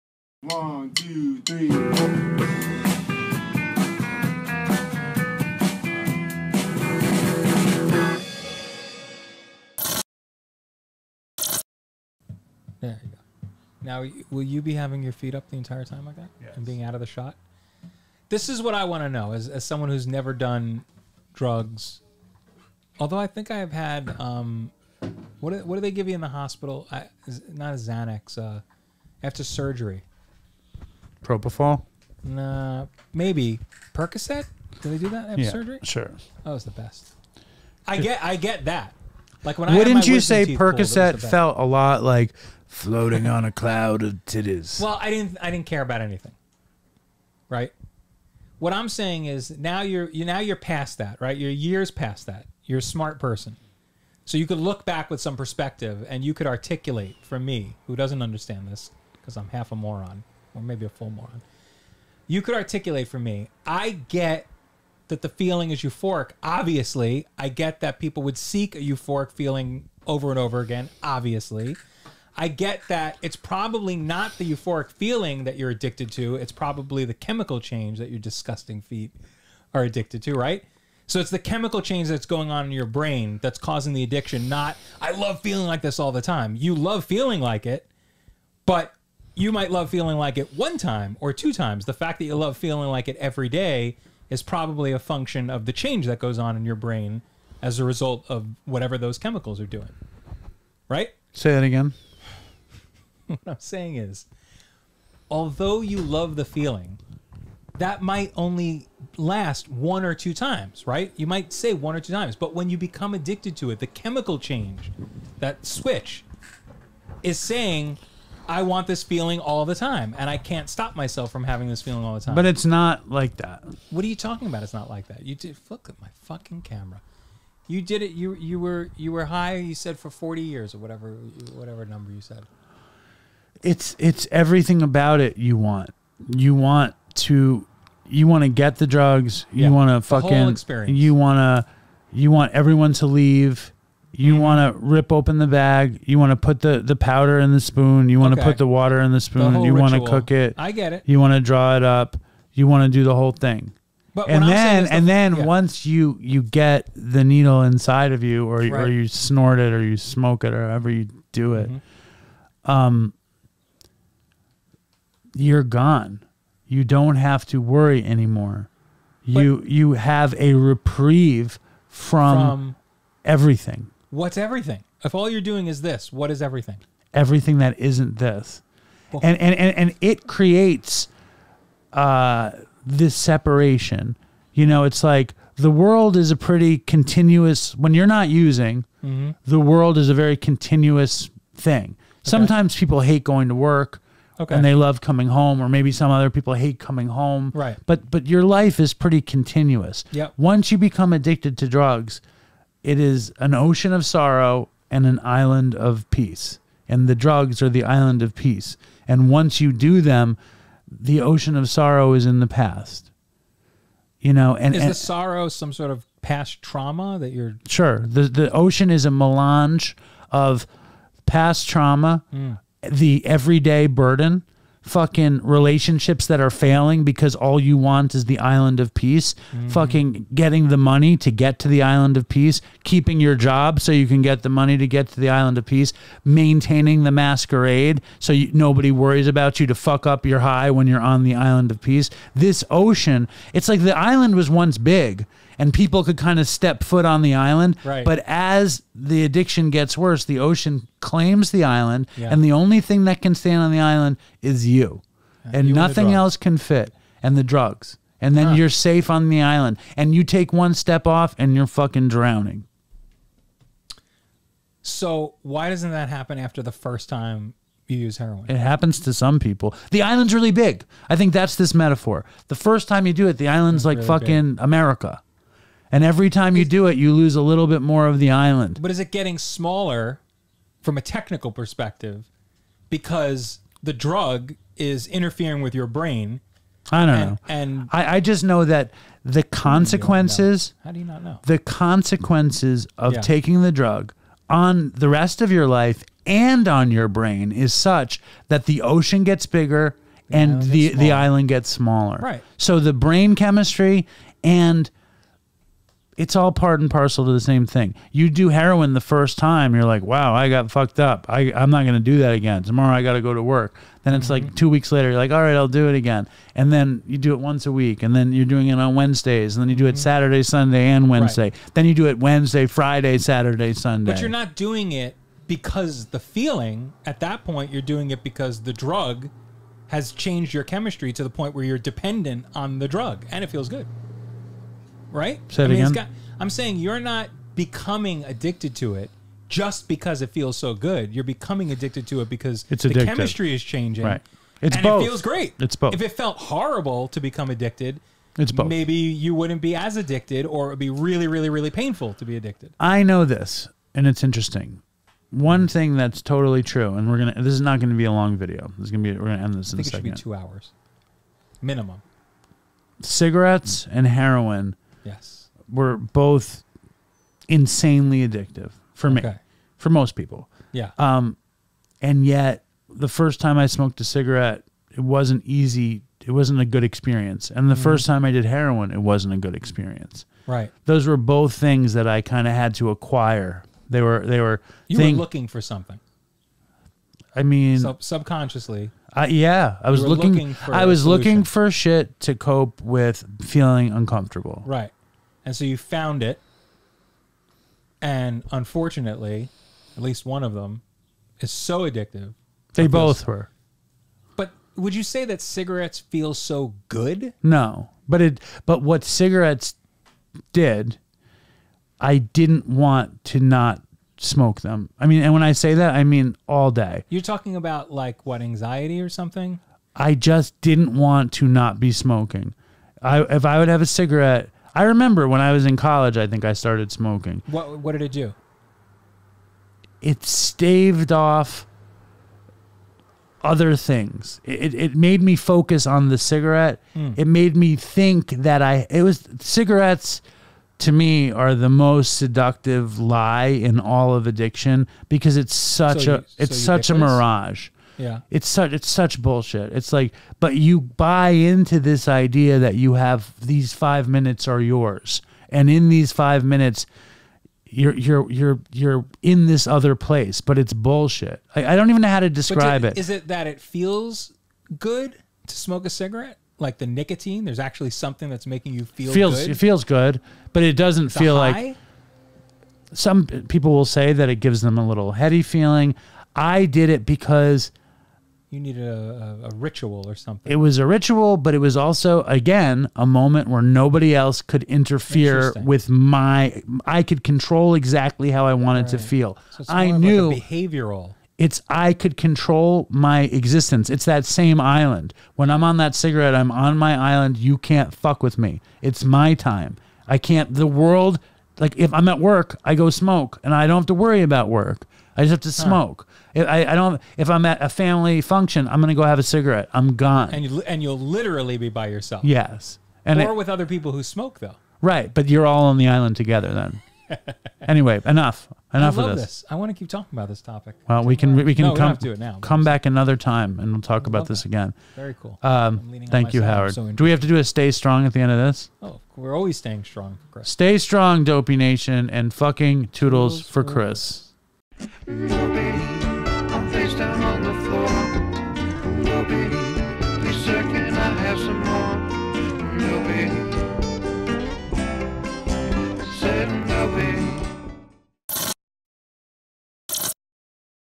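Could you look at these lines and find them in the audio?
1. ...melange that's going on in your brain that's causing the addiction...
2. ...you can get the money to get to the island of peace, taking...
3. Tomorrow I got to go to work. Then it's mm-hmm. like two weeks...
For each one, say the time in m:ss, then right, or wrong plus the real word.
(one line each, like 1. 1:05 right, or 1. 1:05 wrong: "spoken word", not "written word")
1. 1:21 wrong: "change", not "melange"
2. 3:53 wrong: "maintaining", not "taking"
3. 5:12 right.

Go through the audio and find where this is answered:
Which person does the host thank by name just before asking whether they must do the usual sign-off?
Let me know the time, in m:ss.
8:46.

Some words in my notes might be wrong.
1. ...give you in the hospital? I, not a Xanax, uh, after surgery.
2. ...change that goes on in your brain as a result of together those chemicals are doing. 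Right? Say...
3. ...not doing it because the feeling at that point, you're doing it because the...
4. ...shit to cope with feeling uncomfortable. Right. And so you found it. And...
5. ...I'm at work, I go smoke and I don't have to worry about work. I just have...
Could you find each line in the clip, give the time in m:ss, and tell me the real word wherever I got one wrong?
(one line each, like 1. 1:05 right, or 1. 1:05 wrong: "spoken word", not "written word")
1. 0:25 right
2. 1:35 wrong: "whatever", not "together"
3. 5:24 right
4. 6:31 right
5. 8:21 right.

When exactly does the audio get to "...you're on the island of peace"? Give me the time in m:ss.
4:00.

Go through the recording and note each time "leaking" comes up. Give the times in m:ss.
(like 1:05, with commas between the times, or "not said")
not said.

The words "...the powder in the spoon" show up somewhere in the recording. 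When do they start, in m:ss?
2:26.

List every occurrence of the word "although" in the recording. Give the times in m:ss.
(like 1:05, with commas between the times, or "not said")
0:22, 1:45.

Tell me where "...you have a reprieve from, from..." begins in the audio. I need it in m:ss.
2:49.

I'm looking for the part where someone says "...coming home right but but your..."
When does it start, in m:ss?
3:16.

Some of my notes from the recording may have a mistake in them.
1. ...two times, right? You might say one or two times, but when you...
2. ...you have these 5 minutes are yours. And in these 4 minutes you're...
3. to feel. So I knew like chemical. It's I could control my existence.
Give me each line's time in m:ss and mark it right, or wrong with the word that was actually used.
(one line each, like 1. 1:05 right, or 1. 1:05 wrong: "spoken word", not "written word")
1. 1:50 right
2. 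7:32 wrong: "5", not "4"
3. 8:08 wrong: "behavioral", not "chemical".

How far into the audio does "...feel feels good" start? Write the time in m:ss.
7:48.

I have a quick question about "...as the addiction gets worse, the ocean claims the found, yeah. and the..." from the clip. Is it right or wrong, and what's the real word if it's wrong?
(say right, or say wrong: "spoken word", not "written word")
wrong: "island", not "found".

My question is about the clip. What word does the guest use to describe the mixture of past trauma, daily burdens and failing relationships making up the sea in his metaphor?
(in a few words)
Melange.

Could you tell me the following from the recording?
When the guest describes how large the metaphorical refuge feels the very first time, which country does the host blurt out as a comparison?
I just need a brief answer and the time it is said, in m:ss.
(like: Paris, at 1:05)
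America, at 4:34.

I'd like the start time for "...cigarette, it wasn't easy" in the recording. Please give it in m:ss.
6:14.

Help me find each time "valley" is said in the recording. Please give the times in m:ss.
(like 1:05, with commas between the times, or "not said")
not said.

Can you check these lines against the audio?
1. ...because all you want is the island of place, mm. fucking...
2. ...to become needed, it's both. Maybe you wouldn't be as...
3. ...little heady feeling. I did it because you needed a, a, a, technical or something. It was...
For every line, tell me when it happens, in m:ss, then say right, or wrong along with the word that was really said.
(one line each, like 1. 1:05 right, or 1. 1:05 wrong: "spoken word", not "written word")
1. 3:47 wrong: "peace", not "place"
2. 5:47 wrong: "addicted", not "needed"
3. 7:54 wrong: "ritual", not "technical".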